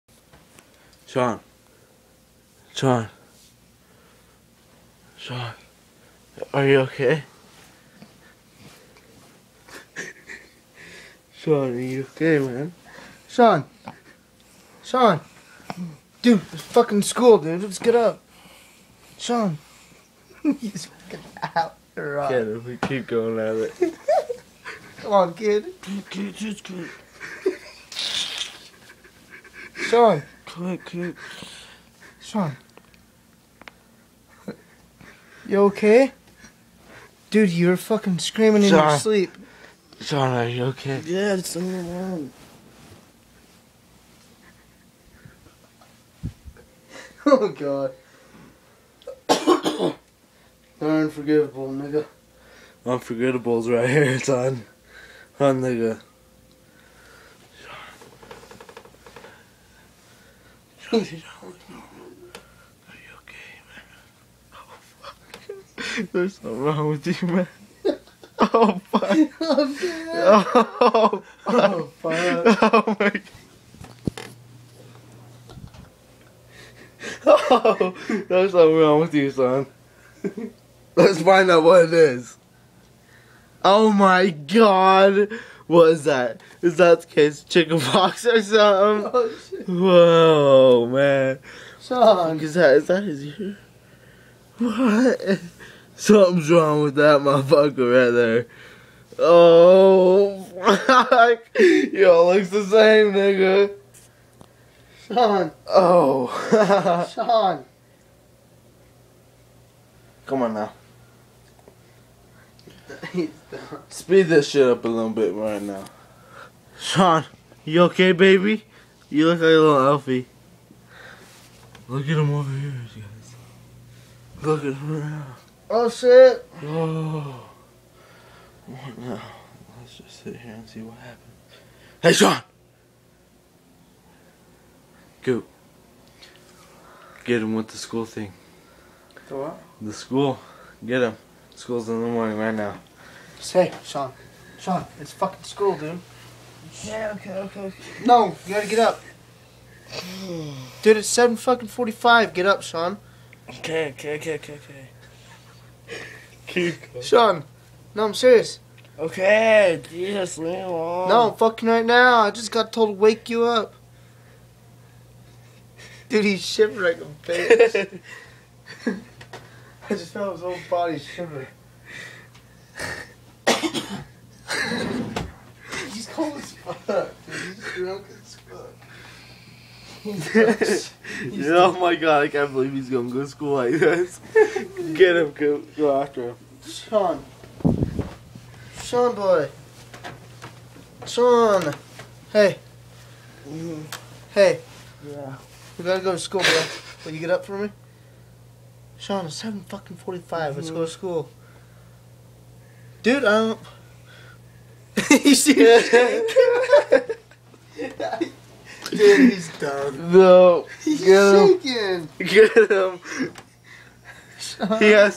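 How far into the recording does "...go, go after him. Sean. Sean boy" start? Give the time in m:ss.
3:05.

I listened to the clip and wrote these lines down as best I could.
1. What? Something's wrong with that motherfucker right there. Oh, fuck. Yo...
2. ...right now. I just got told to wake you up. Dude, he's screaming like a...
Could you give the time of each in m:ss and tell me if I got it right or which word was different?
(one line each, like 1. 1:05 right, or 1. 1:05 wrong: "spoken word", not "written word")
1. 1:34 right
2. 2:41 wrong: "shivering", not "screaming".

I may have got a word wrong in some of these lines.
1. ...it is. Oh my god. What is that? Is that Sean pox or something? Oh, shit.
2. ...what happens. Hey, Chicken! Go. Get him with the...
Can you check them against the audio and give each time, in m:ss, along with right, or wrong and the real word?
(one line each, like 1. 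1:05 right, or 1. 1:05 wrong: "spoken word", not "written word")
1. 1:21 wrong: "Chicken", not "Sean"
2. 2:10 wrong: "Sean", not "Chicken".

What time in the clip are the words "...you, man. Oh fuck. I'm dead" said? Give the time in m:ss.
1:07.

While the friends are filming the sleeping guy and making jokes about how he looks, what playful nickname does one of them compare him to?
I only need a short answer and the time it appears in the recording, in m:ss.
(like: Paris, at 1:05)
Elfie, at 1:59.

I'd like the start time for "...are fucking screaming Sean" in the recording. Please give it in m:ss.
0:37.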